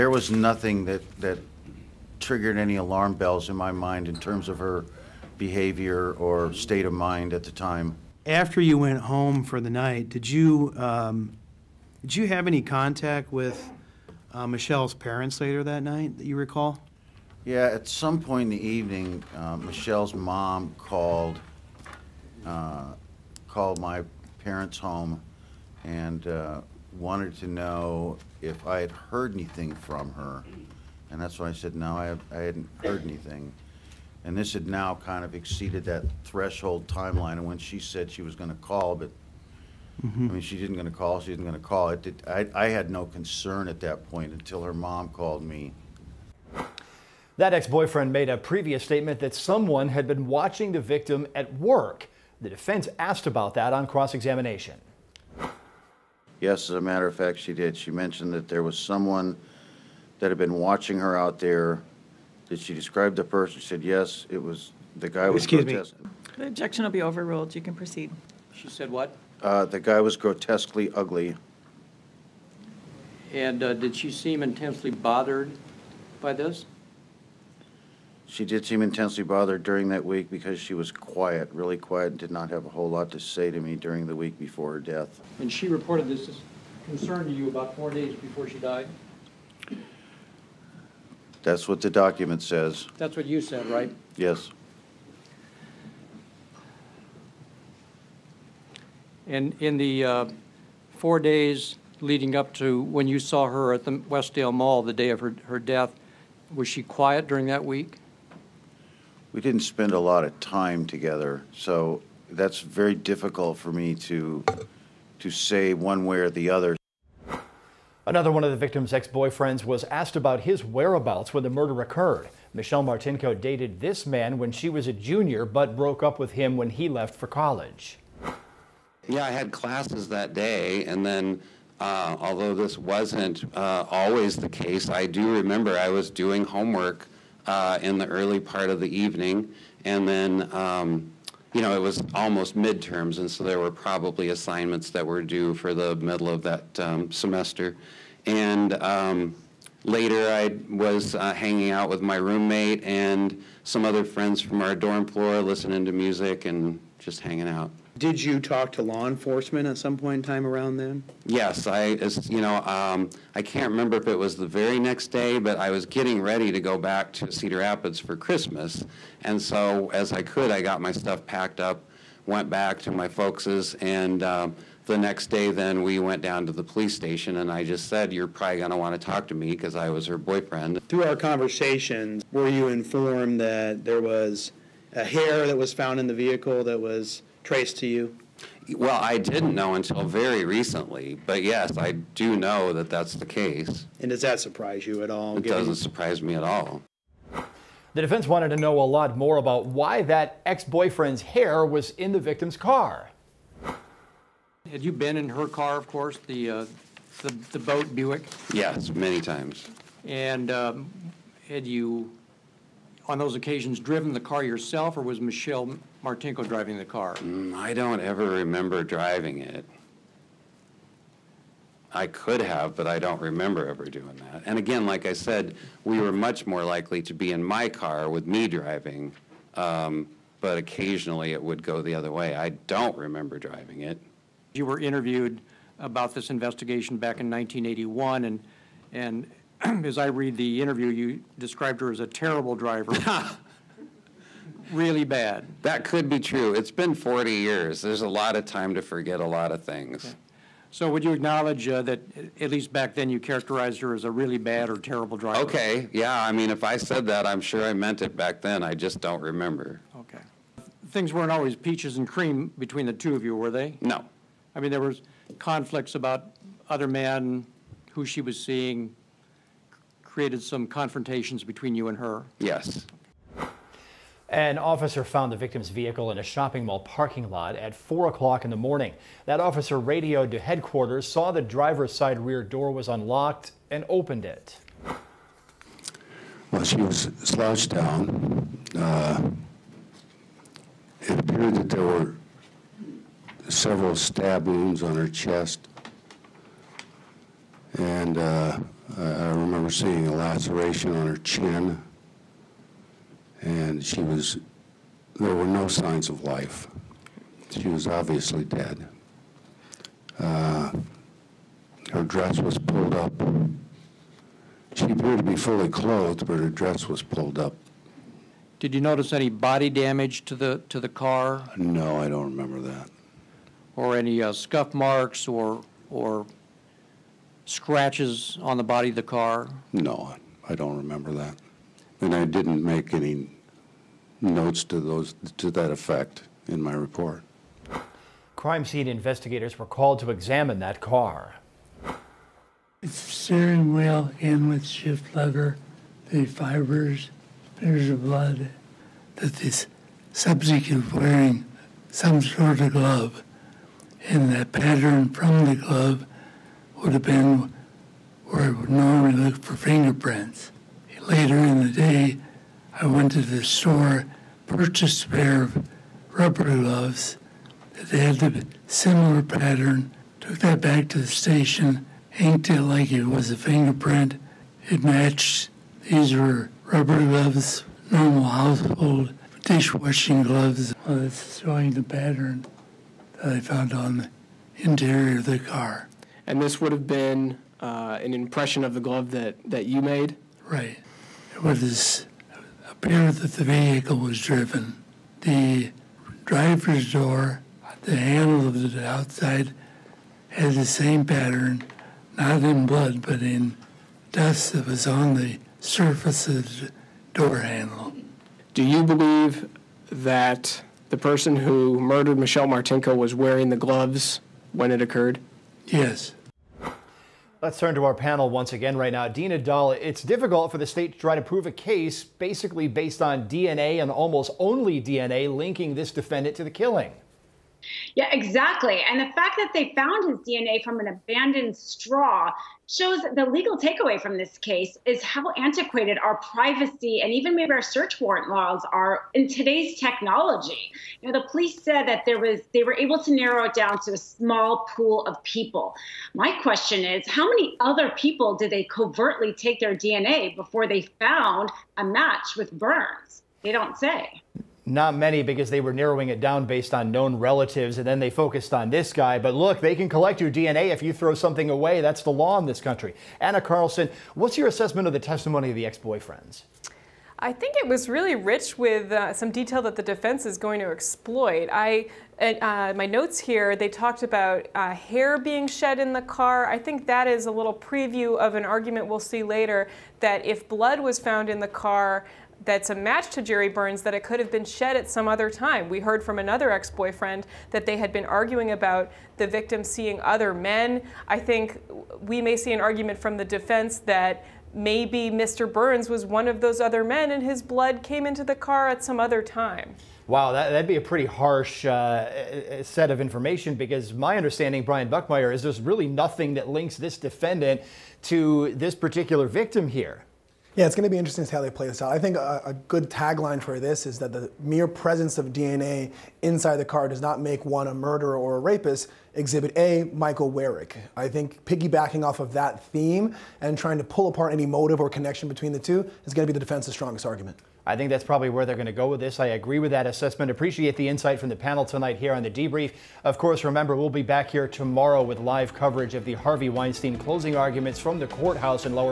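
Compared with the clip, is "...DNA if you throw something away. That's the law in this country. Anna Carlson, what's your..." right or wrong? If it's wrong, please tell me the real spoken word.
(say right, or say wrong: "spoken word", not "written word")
right.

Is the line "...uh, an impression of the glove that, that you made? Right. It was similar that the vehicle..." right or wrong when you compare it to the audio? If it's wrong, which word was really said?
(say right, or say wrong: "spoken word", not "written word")
wrong: "appear", not "similar".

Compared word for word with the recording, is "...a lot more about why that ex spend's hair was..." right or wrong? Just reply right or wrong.
wrong.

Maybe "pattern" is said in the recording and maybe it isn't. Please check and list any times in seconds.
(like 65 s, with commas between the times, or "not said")
354 s, 369 s, 381 s, 401 s.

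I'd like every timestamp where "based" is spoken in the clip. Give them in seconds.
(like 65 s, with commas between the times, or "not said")
422 s, 456 s.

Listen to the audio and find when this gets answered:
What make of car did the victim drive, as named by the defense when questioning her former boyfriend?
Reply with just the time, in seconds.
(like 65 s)
207 s.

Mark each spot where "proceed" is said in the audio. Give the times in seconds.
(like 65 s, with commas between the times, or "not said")
67 s.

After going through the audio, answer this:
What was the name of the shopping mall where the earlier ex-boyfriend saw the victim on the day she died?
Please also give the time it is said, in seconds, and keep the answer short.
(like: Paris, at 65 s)
Westdale Mall, at 103 s.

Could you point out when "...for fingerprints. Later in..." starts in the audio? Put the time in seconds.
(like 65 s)
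359 s.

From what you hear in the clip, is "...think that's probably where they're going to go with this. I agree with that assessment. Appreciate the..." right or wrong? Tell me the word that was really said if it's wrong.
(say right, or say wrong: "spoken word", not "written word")
right.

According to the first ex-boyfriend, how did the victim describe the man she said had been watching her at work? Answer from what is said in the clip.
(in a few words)
grotesquely ugly.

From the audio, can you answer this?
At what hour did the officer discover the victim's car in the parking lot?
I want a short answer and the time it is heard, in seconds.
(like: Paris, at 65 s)
4 o'clock, at 277 s.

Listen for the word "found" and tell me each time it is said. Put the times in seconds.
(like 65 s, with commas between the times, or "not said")
185 s, 275 s, 383 s, 429 s, 450 s, 480 s.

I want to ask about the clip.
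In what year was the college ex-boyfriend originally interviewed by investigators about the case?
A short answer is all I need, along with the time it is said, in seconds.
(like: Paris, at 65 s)
1981, at 237 s.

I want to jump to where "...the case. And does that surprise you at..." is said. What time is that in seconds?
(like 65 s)
193 s.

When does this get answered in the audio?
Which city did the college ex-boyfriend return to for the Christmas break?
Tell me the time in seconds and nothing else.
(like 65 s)
167 s.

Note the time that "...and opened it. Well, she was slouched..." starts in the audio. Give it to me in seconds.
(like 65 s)
283 s.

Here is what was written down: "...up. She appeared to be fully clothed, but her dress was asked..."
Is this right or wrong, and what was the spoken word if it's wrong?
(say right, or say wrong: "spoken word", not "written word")
wrong: "pulled", not "asked".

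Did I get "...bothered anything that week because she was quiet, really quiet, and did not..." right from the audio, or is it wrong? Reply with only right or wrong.
wrong.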